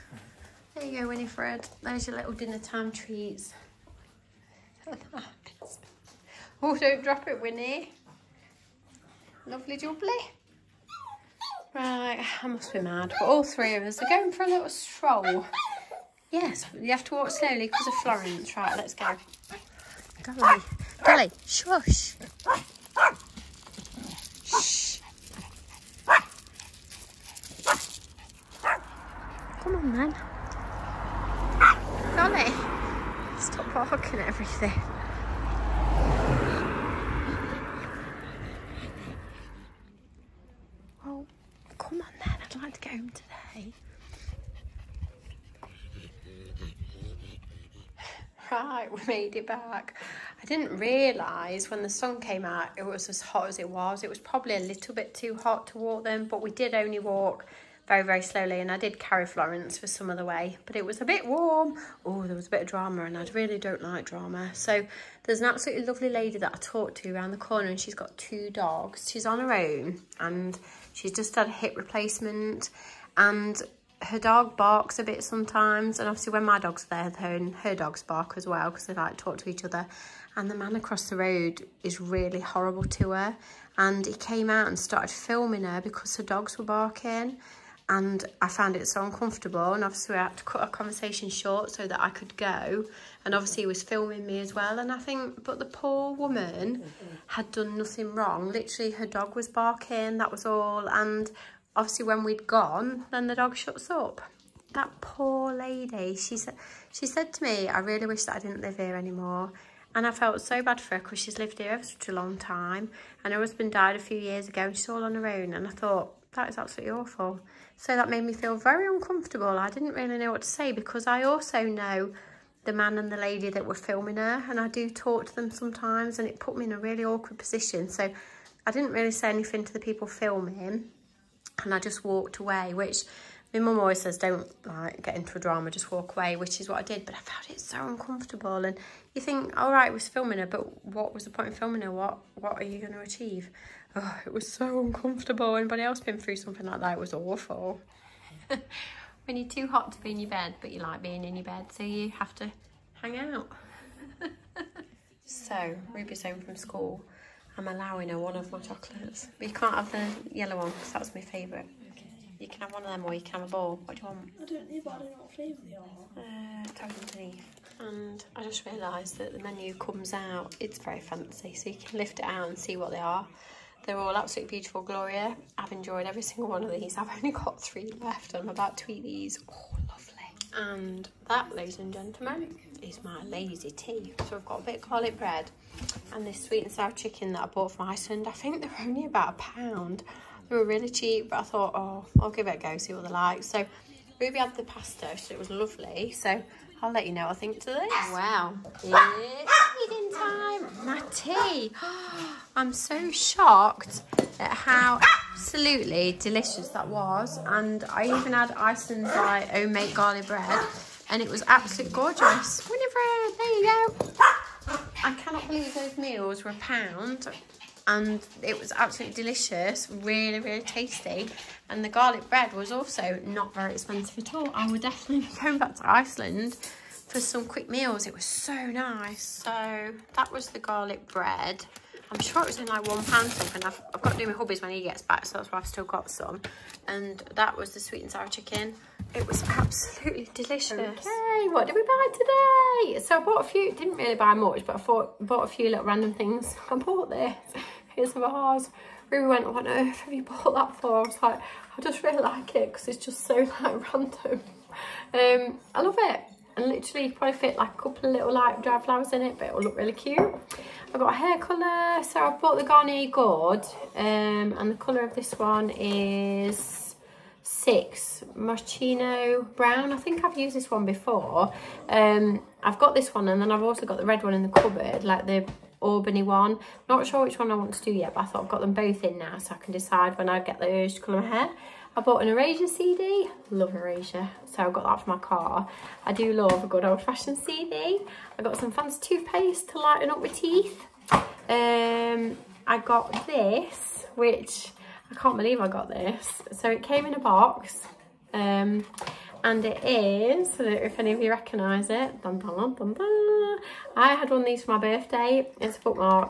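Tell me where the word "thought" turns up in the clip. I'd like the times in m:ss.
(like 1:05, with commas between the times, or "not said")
1:55, 3:11, 4:38.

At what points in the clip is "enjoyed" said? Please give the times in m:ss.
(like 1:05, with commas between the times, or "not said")
2:55.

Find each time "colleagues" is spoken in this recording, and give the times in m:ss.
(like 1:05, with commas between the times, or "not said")
not said.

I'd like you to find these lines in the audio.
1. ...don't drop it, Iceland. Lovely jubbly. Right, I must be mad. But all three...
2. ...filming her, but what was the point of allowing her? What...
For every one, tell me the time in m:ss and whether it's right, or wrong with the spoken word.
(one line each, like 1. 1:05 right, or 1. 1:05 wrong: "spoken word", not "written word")
1. 0:06 wrong: "Winnie", not "Iceland"
2. 2:20 wrong: "filming", not "allowing".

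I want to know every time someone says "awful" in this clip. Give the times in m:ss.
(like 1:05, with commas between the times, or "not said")
1:56, 2:27.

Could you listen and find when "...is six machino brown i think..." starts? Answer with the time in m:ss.
4:25.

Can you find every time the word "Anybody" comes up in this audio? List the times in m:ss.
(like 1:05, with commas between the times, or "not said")
2:25.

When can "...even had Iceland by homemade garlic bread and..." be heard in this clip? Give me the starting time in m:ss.
3:28.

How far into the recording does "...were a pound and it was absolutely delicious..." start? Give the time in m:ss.
3:36.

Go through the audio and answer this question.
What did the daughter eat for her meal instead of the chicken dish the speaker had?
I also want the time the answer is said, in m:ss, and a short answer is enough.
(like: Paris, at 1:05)
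pasta, at 3:14.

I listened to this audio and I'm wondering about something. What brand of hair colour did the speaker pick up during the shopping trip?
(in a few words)
Garnier.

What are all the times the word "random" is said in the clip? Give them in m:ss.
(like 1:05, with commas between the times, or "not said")
4:05, 4:13.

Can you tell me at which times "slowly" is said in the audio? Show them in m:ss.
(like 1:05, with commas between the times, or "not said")
0:17, 0:58.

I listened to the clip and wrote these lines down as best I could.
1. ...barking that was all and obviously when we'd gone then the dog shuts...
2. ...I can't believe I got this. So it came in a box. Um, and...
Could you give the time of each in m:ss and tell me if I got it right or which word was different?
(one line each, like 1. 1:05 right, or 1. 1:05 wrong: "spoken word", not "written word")
1. 1:39 right
2. 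4:55 right.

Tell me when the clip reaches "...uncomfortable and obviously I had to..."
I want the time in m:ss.
1:29.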